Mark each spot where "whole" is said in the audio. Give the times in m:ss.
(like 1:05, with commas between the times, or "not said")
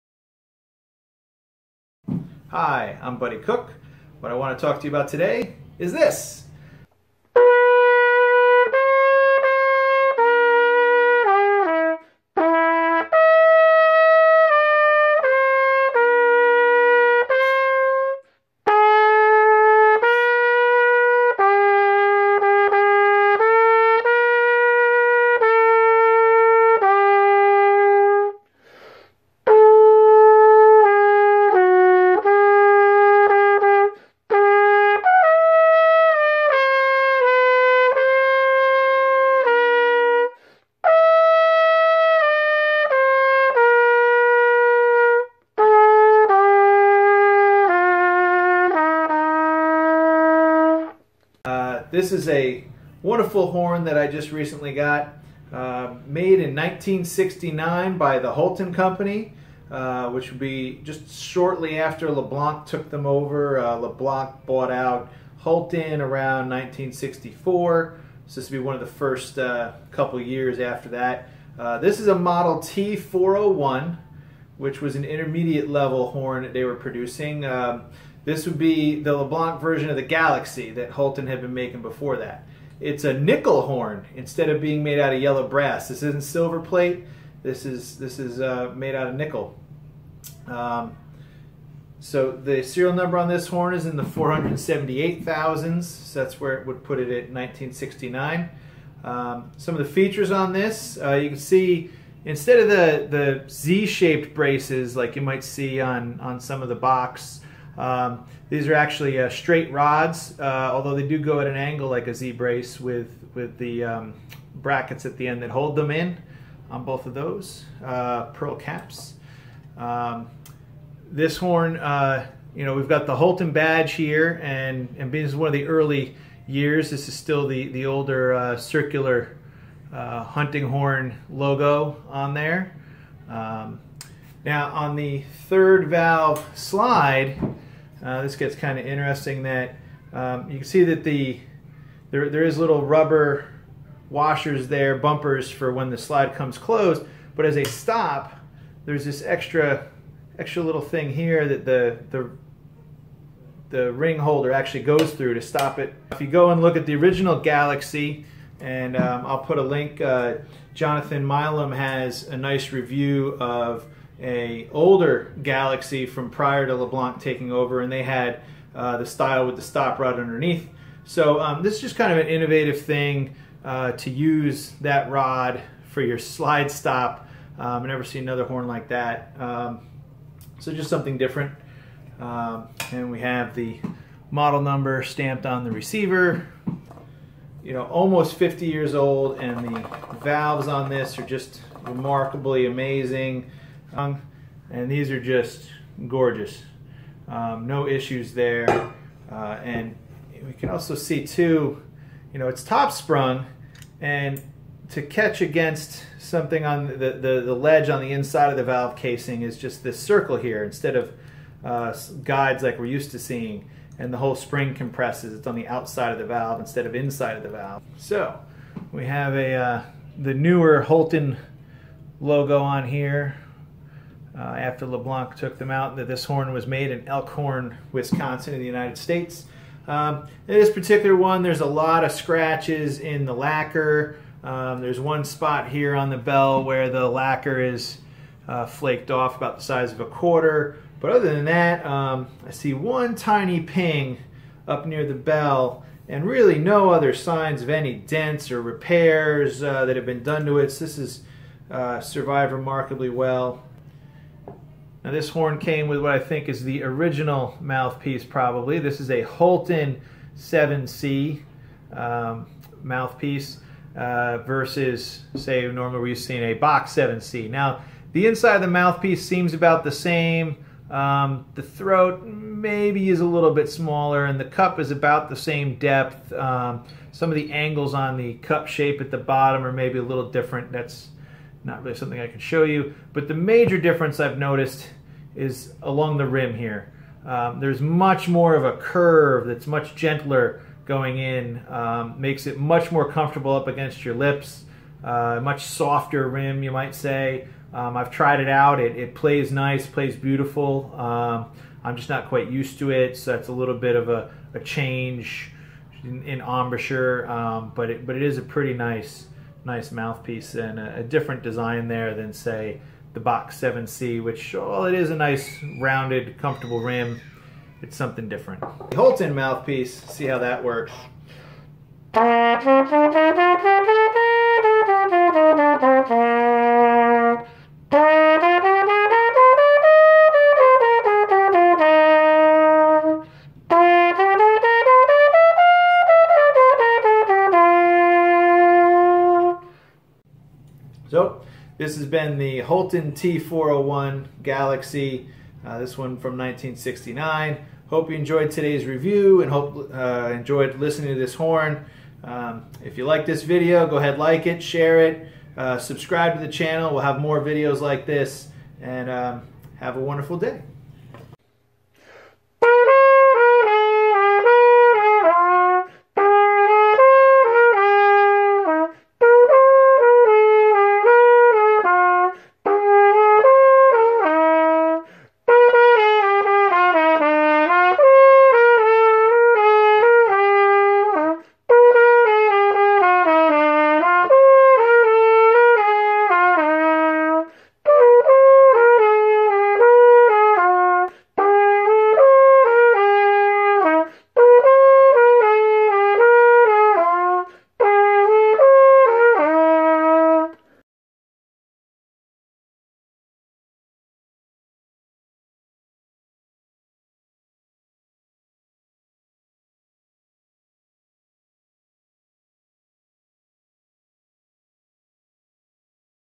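3:34.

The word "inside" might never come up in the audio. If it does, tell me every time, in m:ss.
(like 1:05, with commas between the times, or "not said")
3:28, 3:36, 4:28.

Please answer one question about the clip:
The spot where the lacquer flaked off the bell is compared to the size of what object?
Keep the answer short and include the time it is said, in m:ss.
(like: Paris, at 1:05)
A quarter, at 3:59.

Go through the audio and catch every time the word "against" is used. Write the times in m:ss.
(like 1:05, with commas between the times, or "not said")
3:25, 4:53.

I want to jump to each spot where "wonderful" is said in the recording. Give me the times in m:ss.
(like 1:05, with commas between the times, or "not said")
0:53, 6:00.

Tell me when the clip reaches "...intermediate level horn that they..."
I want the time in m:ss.
1:15.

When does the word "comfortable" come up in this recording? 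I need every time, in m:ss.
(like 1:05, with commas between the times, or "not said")
4:53, 5:16.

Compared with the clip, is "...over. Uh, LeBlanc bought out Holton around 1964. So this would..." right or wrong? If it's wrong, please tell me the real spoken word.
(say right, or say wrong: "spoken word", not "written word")
right.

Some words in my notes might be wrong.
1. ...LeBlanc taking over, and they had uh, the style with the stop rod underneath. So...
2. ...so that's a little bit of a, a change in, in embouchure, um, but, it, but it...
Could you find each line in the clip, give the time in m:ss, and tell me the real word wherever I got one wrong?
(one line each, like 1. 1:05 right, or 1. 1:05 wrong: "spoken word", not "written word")
1. 2:46 right
2. 5:03 right.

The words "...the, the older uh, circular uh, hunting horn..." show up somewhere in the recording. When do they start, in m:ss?
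2:07.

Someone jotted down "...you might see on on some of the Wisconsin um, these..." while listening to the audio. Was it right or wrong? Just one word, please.
wrong.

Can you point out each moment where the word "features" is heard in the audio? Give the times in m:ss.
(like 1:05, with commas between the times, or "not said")
1:39.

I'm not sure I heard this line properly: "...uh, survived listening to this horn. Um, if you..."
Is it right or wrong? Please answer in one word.
wrong.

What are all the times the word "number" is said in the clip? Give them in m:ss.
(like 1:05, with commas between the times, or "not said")
1:32, 3:04.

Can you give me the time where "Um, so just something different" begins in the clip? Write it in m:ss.
2:59.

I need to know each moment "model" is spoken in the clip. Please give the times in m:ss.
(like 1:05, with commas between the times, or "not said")
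1:12, 3:04.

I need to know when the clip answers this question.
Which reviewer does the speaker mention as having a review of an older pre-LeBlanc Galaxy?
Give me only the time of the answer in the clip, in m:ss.
2:40.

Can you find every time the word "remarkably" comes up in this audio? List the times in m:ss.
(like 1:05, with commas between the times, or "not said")
3:11, 4:12.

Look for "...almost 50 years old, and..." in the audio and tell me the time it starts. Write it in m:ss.
3:07.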